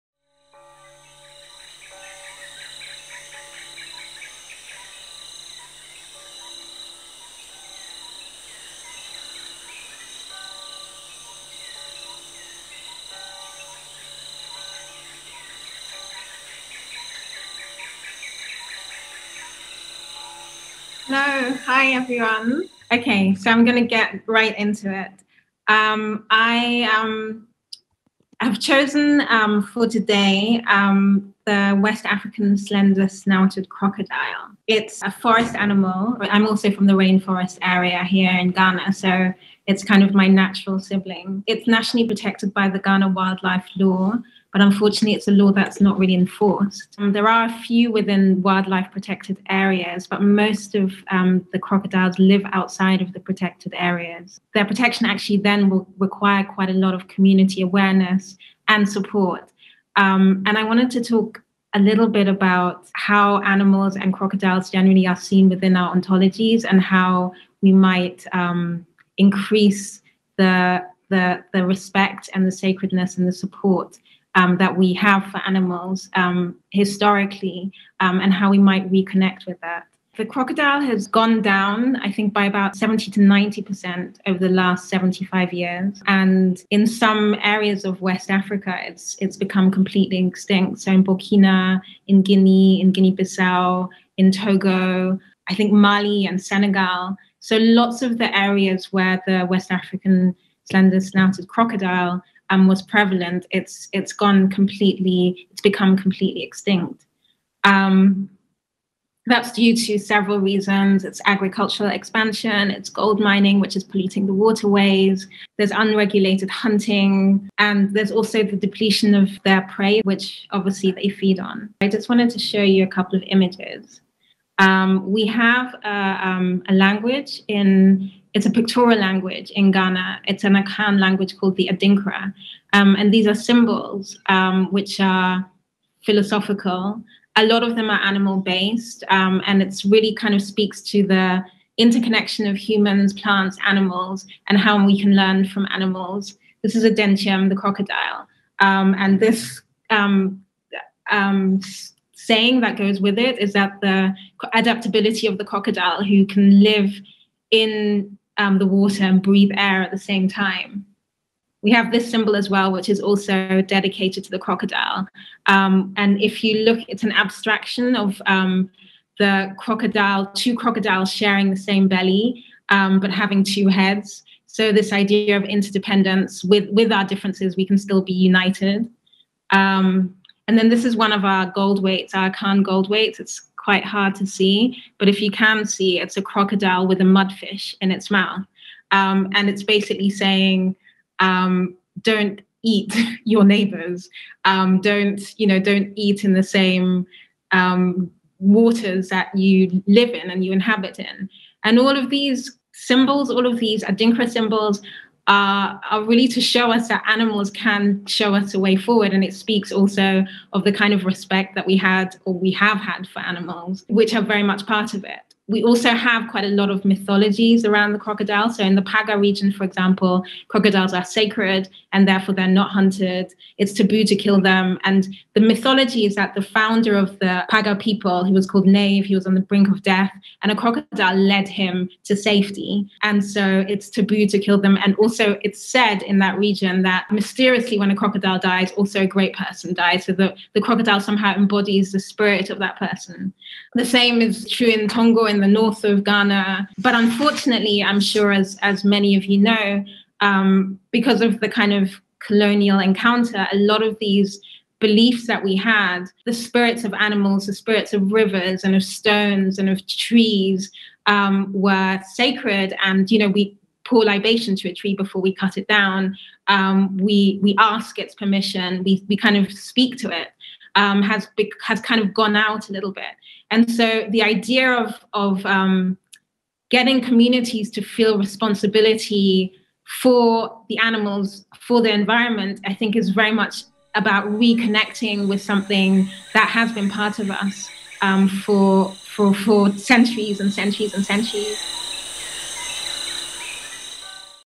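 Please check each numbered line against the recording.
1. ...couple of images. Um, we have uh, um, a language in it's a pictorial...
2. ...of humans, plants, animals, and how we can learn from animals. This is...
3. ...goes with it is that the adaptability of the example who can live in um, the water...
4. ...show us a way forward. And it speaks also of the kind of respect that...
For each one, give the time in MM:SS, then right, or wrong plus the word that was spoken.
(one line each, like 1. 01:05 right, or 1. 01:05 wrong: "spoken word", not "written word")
1. 02:02 right
2. 02:22 right
3. 02:32 wrong: "crocodile", not "example"
4. 03:28 right.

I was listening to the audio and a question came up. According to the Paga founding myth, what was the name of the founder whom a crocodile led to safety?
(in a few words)
Nave.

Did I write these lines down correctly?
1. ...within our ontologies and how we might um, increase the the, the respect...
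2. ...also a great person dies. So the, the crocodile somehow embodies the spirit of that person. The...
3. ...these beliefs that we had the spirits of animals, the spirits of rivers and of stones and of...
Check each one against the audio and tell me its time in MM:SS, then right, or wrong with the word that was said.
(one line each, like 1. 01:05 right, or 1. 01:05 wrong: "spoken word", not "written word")
1. 01:05 right
2. 03:58 right
3. 04:13 right.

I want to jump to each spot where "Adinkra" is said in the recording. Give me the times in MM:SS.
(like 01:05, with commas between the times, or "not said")
02:11, 03:23.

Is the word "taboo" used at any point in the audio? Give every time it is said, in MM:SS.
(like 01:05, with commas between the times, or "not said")
03:43, 03:53.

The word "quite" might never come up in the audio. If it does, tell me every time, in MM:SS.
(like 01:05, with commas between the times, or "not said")
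00:56, 03:03, 03:36.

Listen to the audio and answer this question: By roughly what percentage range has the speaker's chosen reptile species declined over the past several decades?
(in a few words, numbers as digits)
70 to 90%.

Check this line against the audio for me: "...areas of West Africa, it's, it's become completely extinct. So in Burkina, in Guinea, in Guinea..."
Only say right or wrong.
right.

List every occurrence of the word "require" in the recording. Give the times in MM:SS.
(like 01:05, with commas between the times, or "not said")
00:55.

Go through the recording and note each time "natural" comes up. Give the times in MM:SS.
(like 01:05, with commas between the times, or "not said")
00:40.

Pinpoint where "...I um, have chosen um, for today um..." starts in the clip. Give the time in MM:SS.
00:26.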